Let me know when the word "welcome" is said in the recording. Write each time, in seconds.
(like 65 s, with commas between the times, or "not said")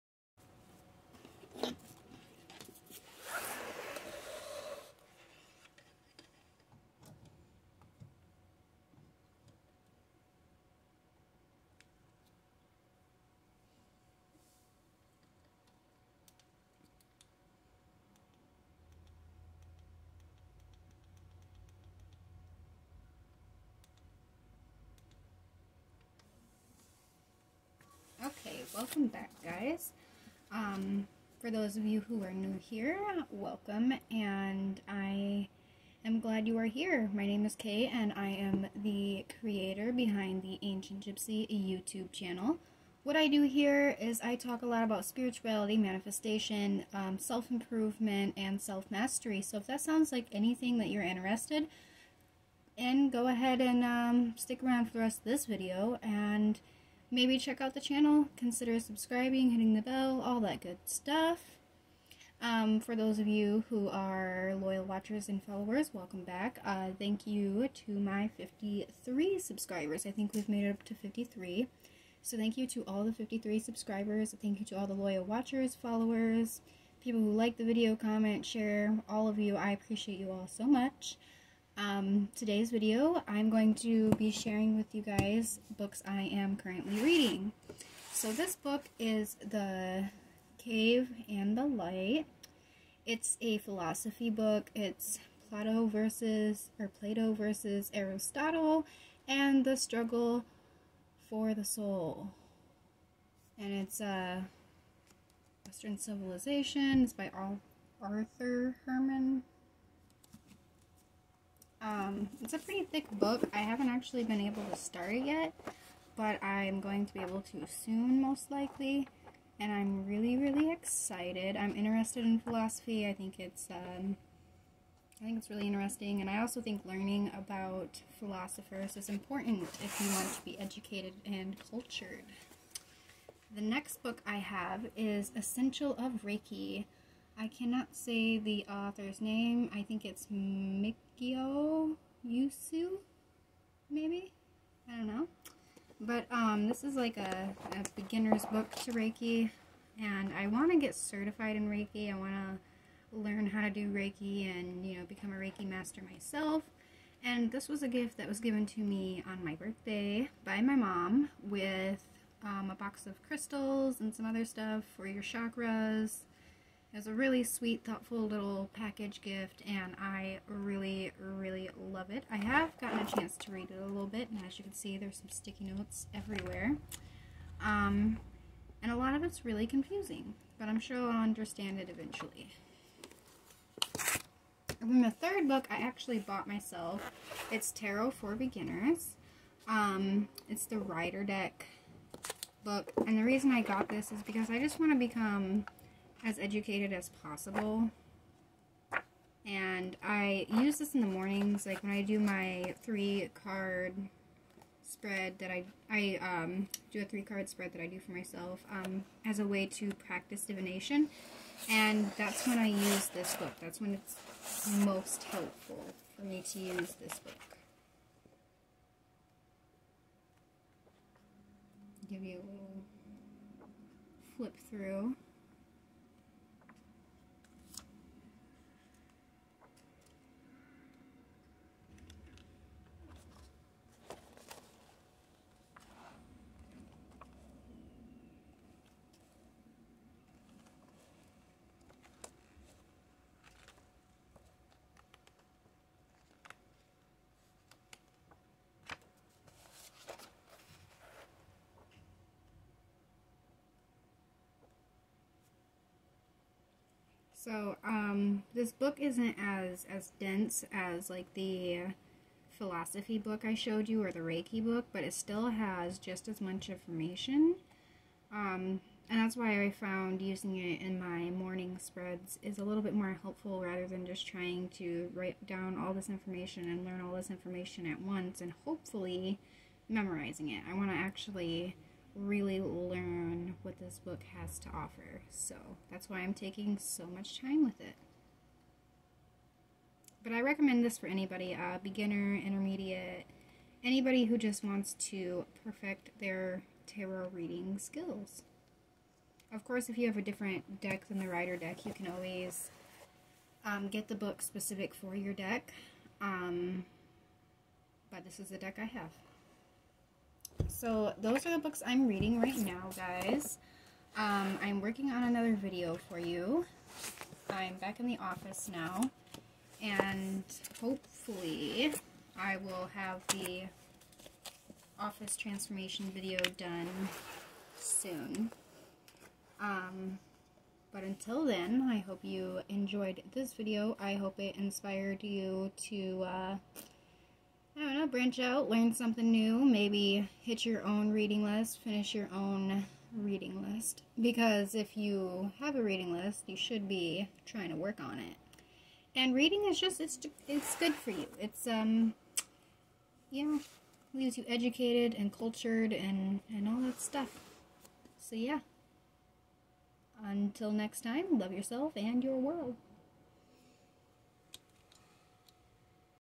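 28 s, 33 s, 65 s.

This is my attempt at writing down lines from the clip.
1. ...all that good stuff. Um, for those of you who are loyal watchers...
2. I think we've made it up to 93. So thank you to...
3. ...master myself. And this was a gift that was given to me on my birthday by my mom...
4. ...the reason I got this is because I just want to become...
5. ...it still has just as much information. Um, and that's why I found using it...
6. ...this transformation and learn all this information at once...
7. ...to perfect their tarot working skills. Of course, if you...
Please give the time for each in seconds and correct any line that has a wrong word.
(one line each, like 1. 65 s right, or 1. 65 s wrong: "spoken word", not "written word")
1. 60 s right
2. 70 s wrong: "53", not "93"
3. 155 s right
4. 193 s right
5. 265 s right
6. 275 s wrong: "information", not "transformation"
7. 295 s wrong: "reading", not "working".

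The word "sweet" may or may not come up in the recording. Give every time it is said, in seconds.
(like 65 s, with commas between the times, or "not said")
167 s.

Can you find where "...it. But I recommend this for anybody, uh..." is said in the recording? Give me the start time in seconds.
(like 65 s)
287 s.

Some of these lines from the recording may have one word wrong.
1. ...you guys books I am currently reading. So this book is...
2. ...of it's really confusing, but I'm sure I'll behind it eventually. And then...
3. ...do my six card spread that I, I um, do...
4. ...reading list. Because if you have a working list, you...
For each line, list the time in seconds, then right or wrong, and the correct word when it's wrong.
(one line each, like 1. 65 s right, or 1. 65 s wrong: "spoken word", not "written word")
1. 84 s right
2. 179 s wrong: "understand", not "behind"
3. 202 s wrong: "three", not "six"
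4. 343 s wrong: "reading", not "working".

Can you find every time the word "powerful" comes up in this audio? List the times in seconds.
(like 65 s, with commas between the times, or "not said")
not said.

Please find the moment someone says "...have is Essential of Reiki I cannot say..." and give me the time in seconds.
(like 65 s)
134 s.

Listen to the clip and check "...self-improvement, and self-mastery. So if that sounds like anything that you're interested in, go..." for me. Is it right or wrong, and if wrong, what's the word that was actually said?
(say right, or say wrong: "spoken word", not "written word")
right.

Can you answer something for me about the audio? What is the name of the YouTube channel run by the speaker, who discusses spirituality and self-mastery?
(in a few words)
Ancient Gypsy.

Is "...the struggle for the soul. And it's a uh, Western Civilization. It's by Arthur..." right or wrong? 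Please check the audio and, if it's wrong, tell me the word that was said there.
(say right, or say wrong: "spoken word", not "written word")
right.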